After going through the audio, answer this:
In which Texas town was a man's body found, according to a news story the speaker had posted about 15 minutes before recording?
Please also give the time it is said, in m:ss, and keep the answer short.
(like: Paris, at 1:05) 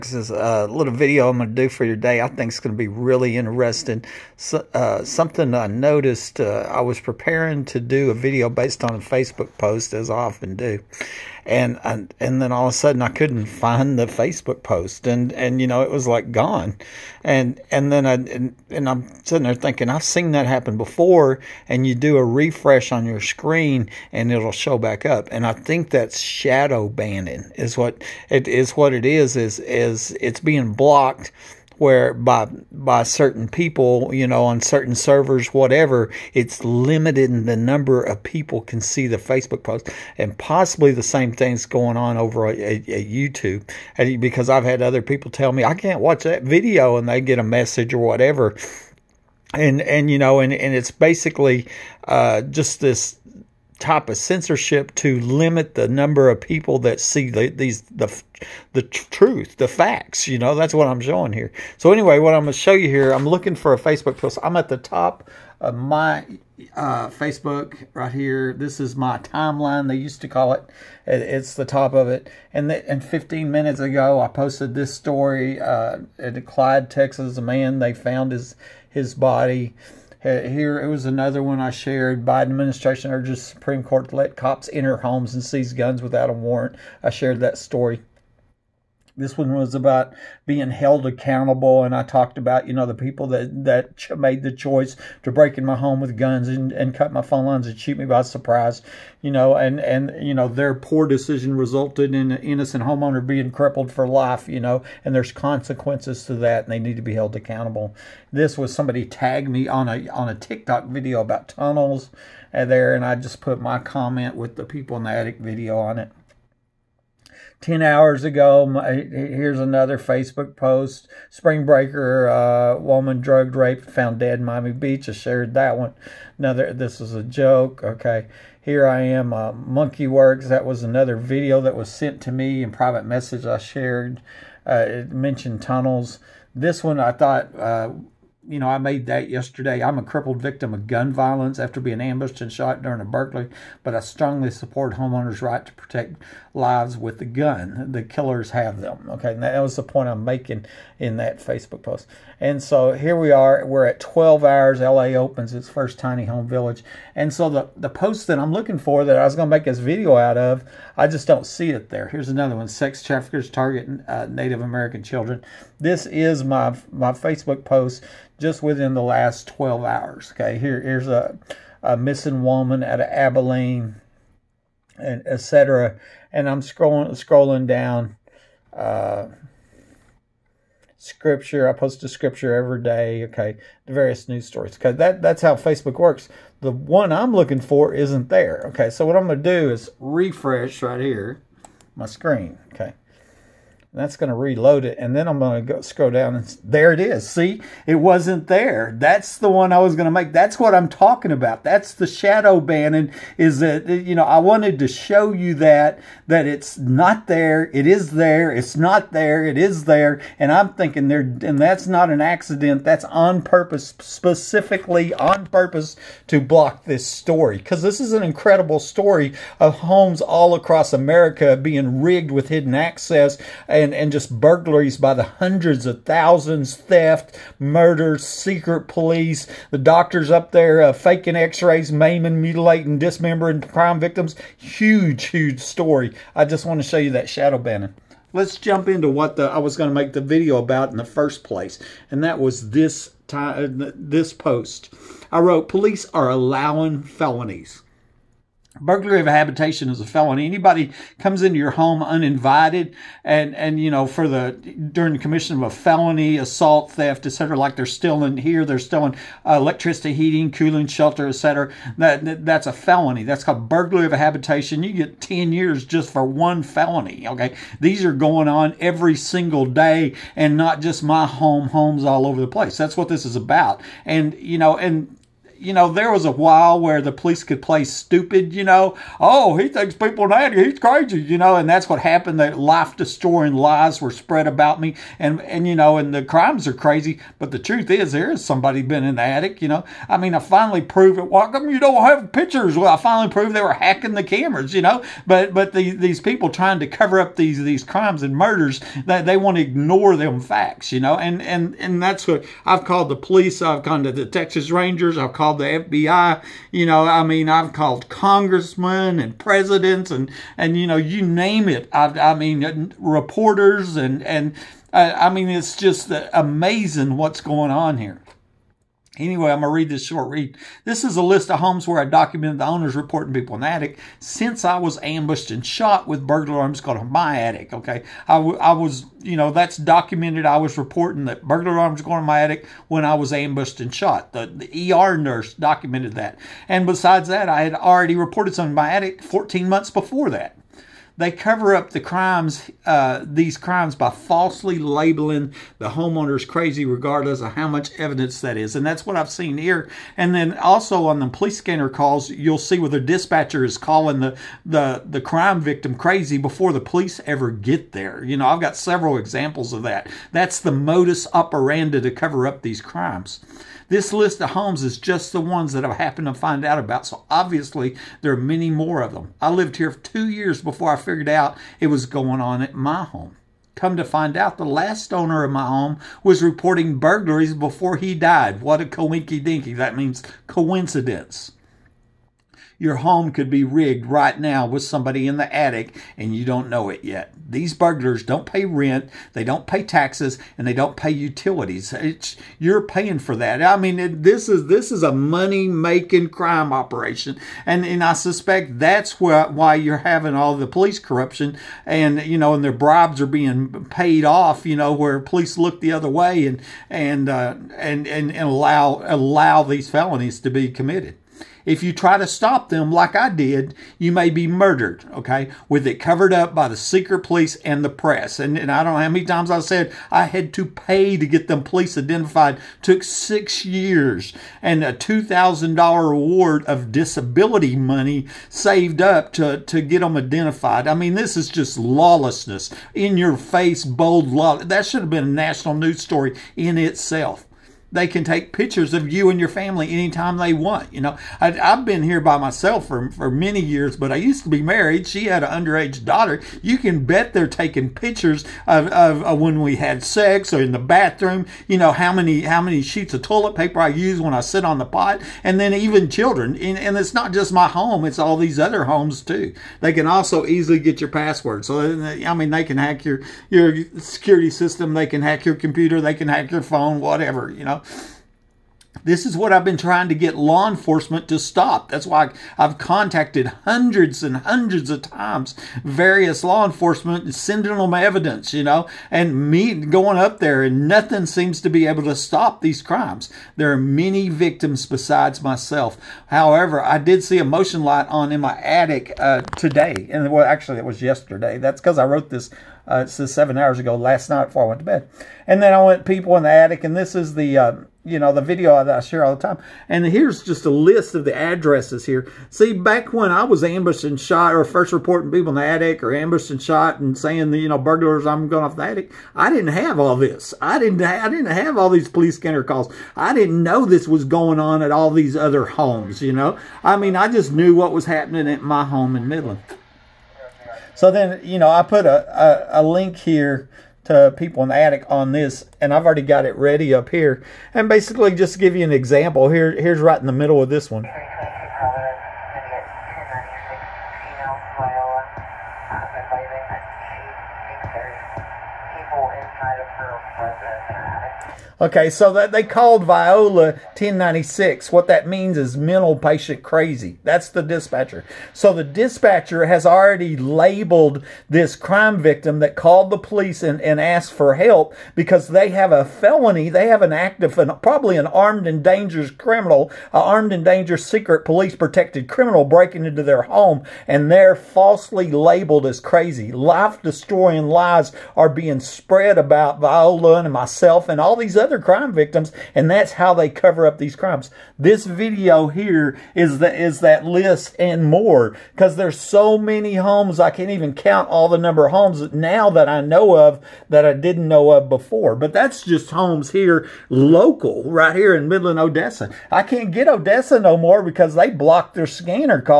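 Clyde, Texas, at 1:16.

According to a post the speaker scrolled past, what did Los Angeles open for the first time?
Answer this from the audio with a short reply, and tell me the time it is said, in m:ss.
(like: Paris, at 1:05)
tiny home village, at 2:35.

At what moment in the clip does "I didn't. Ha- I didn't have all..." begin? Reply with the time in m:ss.
8:30.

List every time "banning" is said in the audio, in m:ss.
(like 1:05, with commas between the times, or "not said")
0:26, 3:22, 3:57.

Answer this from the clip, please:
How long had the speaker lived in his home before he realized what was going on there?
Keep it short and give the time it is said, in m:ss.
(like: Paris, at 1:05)
two years, at 6:09.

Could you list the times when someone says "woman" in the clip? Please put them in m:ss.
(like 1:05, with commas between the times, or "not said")
2:02, 2:52.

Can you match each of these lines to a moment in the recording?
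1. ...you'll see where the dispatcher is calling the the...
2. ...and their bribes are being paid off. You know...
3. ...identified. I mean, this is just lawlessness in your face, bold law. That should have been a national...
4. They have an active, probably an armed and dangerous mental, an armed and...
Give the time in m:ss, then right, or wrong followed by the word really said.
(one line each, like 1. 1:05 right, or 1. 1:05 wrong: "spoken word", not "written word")
1. 5:52 right
2. 6:42 right
3. 7:10 right
4. 9:16 wrong: "criminal", not "mental".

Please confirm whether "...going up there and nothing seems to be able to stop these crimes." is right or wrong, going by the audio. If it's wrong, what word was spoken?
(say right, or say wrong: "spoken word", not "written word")
right.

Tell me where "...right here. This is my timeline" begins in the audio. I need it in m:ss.
1:07.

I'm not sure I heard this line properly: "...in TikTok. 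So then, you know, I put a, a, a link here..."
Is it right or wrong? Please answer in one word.
wrong.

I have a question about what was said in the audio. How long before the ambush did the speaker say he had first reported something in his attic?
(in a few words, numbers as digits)
14 months.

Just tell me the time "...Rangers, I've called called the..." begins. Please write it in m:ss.
5:04.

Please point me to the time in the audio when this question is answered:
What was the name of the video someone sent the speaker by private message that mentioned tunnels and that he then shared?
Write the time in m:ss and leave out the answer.
2:09.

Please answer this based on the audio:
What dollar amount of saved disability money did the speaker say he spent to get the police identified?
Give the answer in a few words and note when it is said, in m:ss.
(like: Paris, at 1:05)
$2,000, at 7:04.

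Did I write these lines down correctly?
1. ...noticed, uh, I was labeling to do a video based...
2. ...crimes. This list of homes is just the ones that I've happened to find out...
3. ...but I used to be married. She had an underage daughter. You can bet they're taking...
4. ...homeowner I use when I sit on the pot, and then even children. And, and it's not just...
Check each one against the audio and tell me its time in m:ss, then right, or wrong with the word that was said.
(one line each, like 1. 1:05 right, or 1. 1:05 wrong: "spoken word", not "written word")
1. 0:05 wrong: "preparing", not "labeling"
2. 6:02 right
3. 7:23 right
4. 7:33 wrong: "paper", not "homeowner".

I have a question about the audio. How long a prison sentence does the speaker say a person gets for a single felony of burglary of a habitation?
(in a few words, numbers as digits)
10 years.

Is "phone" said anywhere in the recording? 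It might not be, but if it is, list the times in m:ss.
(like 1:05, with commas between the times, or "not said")
1:37, 7:46.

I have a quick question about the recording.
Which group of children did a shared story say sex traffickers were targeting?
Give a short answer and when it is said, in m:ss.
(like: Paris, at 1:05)
Native American children, at 2:44.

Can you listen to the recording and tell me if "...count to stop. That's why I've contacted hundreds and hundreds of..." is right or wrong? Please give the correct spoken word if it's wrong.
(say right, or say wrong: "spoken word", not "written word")
wrong: "enforcement", not "count".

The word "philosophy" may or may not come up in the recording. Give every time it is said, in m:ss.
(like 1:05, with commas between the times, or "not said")
not said.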